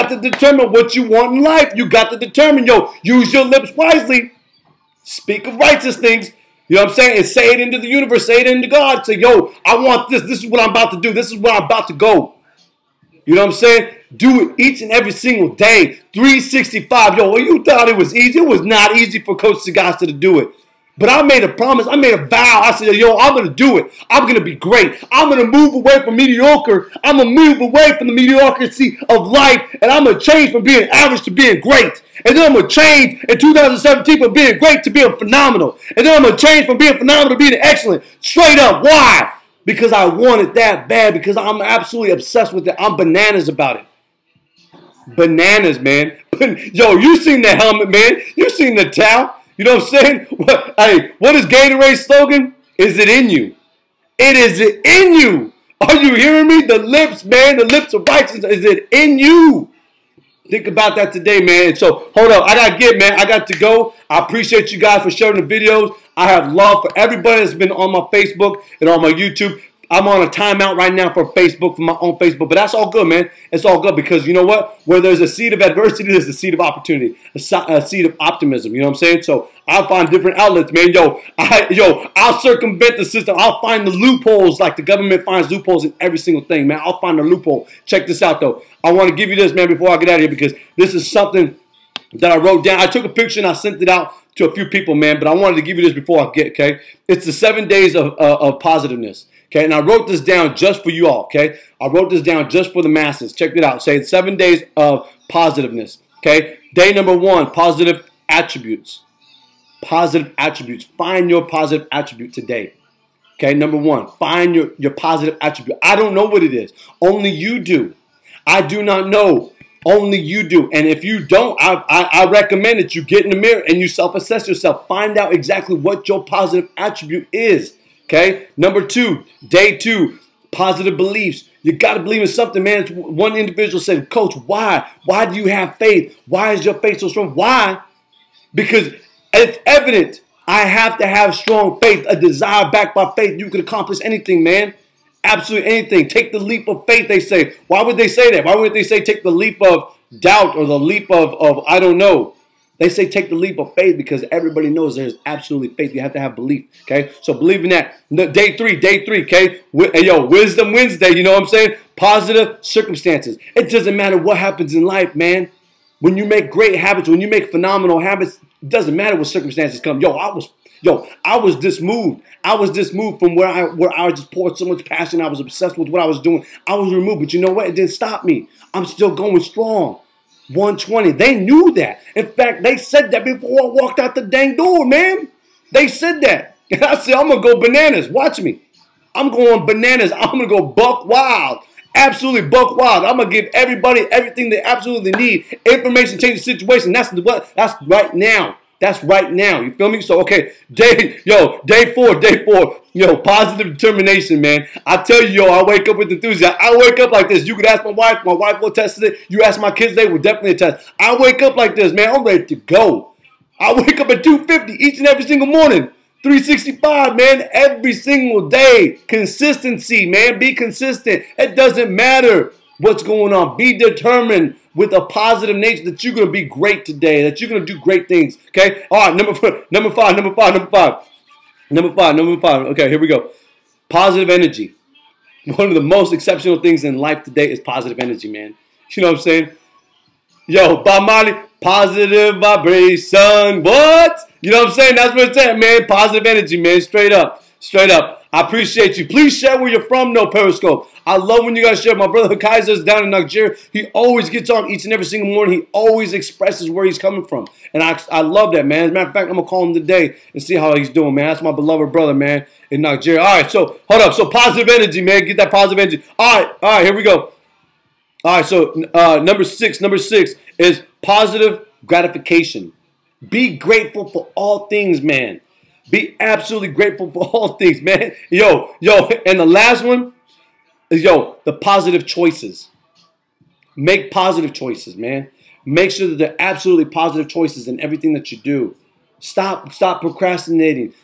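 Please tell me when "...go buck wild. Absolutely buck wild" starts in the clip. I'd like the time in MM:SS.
03:10.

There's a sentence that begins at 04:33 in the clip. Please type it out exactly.
Be grateful for all things, man.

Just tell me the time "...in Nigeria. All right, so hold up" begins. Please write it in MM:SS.
04:22.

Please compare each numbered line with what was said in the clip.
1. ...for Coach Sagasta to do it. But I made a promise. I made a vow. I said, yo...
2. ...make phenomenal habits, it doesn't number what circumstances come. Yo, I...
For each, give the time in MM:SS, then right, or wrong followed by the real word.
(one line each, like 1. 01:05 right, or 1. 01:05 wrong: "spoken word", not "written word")
1. 00:19 right
2. 02:47 wrong: "matter", not "number".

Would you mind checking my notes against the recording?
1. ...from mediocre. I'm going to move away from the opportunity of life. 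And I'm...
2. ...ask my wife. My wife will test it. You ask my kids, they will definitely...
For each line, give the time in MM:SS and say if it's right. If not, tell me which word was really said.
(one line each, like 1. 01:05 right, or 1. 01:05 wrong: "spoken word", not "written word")
1. 00:26 wrong: "mediocrity", not "opportunity"
2. 03:27 right.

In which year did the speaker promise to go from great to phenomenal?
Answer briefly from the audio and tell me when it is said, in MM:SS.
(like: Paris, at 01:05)
2017, at 00:33.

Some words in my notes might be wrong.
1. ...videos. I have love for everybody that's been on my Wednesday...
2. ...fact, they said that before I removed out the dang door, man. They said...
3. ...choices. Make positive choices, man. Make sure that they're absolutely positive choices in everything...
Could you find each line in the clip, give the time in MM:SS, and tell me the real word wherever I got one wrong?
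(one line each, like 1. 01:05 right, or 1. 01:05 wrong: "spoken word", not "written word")
1. 01:05 wrong: "Facebook", not "Wednesday"
2. 03:02 wrong: "walked", not "removed"
3. 04:42 right.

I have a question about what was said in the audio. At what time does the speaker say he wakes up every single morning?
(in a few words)
2:50.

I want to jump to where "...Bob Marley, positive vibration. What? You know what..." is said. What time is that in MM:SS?
04:00.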